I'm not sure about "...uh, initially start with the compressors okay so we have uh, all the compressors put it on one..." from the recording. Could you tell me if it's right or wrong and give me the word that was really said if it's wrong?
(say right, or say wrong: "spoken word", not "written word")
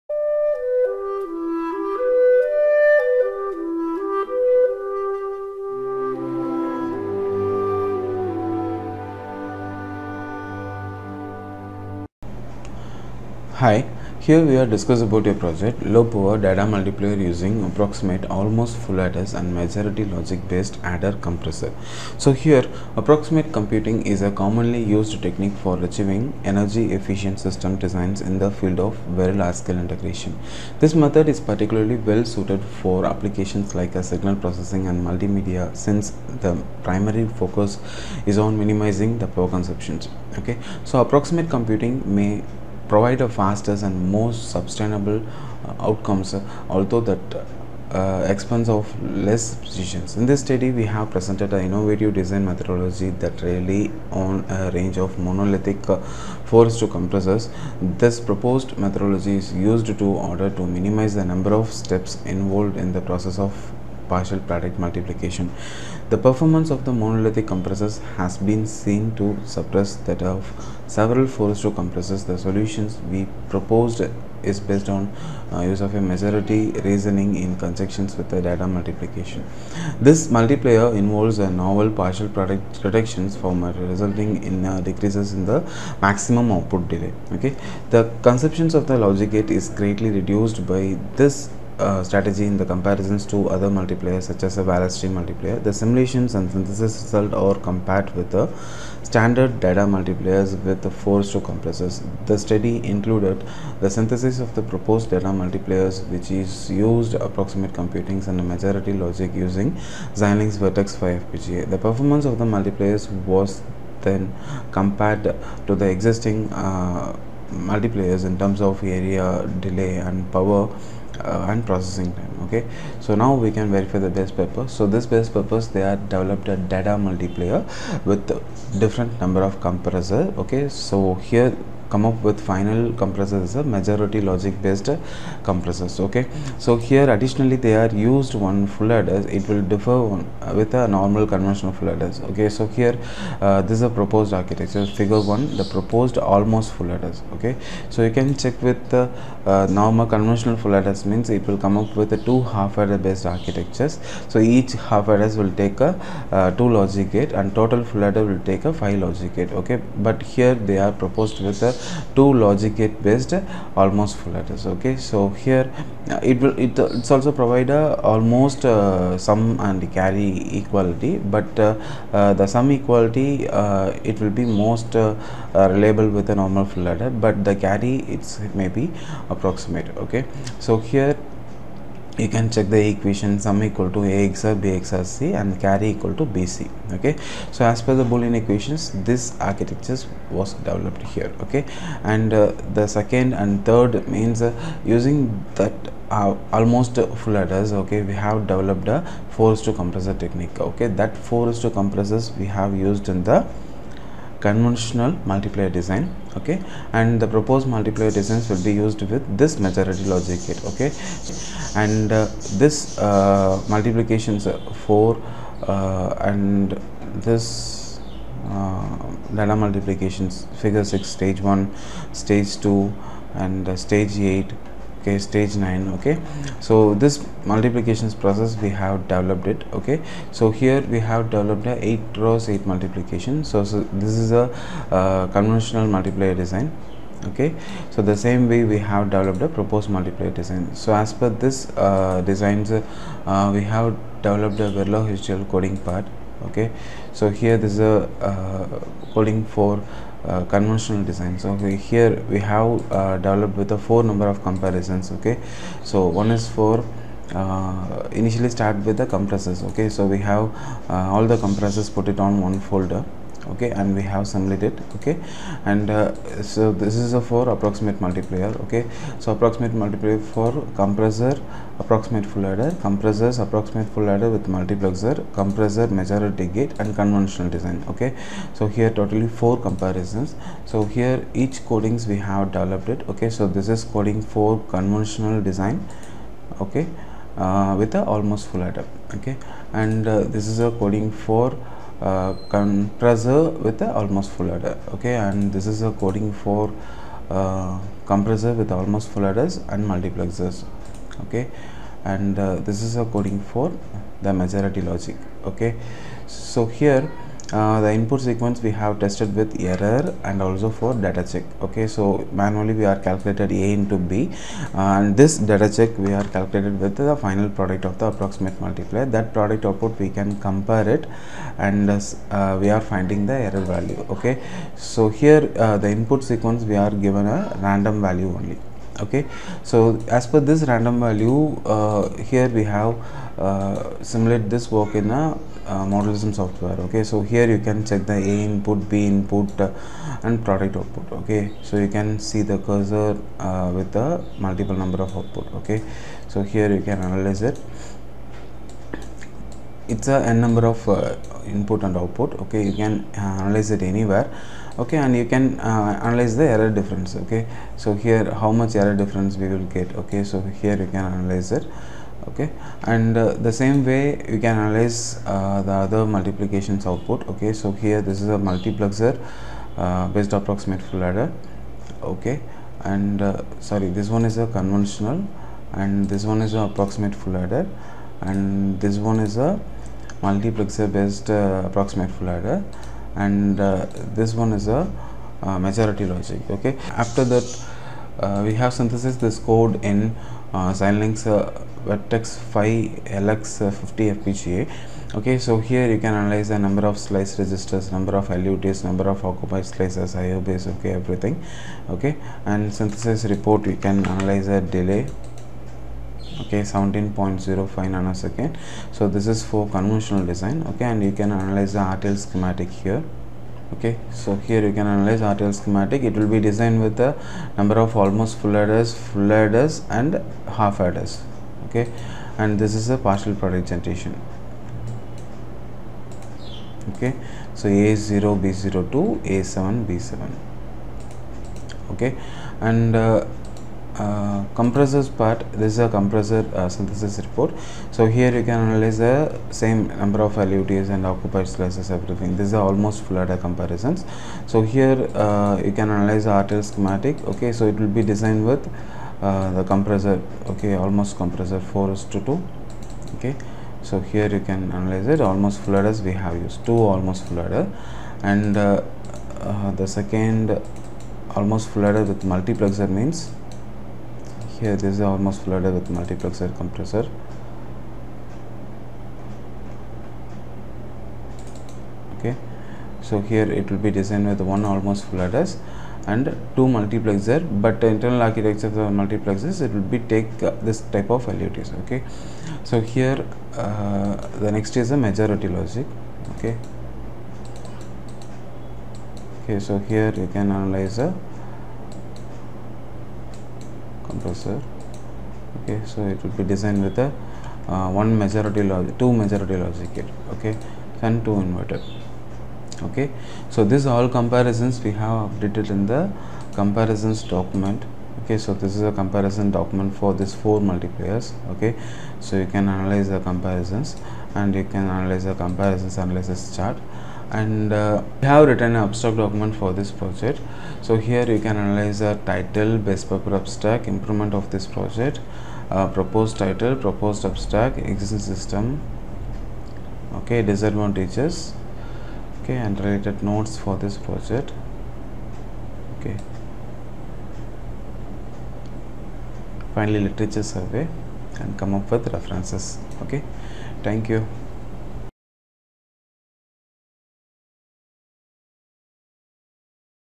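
right.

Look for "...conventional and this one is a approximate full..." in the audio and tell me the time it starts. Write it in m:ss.
6:14.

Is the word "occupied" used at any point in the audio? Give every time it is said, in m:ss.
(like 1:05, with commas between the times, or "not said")
6:39, 7:21.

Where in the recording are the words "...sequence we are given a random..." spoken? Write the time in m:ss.
5:26.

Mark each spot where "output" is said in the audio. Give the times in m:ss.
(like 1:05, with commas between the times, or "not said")
1:26, 5:19, 5:40, 5:45, 5:51, 6:06.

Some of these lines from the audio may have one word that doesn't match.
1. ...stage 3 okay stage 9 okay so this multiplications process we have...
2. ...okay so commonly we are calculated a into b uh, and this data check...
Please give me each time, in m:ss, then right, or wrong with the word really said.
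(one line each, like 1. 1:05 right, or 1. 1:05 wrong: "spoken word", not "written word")
1. 3:43 wrong: "8", not "3"
2. 5:11 wrong: "manually", not "commonly".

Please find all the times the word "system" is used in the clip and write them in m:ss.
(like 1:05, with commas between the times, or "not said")
0:27, 8:48.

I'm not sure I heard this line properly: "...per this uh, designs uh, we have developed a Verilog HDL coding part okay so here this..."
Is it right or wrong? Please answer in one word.
right.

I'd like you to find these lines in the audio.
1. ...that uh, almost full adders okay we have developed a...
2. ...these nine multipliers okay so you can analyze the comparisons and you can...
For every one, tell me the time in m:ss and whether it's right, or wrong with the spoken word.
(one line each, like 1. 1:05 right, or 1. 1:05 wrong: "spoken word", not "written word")
1. 3:15 right
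2. 8:30 wrong: "four", not "nine".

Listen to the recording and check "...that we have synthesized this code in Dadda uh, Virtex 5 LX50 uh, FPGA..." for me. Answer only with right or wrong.
wrong.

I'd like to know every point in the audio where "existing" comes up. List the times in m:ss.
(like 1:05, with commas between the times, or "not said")
1:55, 8:47.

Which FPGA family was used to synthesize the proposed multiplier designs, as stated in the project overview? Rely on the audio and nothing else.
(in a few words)
Xilinx Virtex 5.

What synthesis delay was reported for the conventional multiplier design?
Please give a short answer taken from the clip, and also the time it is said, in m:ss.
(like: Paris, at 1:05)
17.05 nanoseconds, at 6:46.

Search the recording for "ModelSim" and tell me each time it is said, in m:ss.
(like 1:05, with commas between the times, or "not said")
5:35.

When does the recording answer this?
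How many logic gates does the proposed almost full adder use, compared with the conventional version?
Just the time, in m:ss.
2:42.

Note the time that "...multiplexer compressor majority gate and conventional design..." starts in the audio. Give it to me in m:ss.
4:34.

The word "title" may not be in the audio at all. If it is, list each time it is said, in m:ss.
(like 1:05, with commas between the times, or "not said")
8:42, 8:46.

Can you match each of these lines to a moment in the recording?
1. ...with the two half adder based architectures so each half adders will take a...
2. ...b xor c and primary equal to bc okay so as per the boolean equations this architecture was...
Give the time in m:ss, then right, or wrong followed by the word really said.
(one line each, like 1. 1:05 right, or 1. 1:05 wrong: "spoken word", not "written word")
1. 2:32 right
2. 3:04 wrong: "carry", not "primary".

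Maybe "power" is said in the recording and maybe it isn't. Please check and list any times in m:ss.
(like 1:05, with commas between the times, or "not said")
0:16, 0:39, 2:00.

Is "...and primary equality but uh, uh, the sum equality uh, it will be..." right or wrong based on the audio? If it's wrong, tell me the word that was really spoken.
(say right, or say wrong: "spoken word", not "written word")
wrong: "carry", not "primary".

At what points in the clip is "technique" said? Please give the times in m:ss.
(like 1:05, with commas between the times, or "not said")
0:25, 3:20.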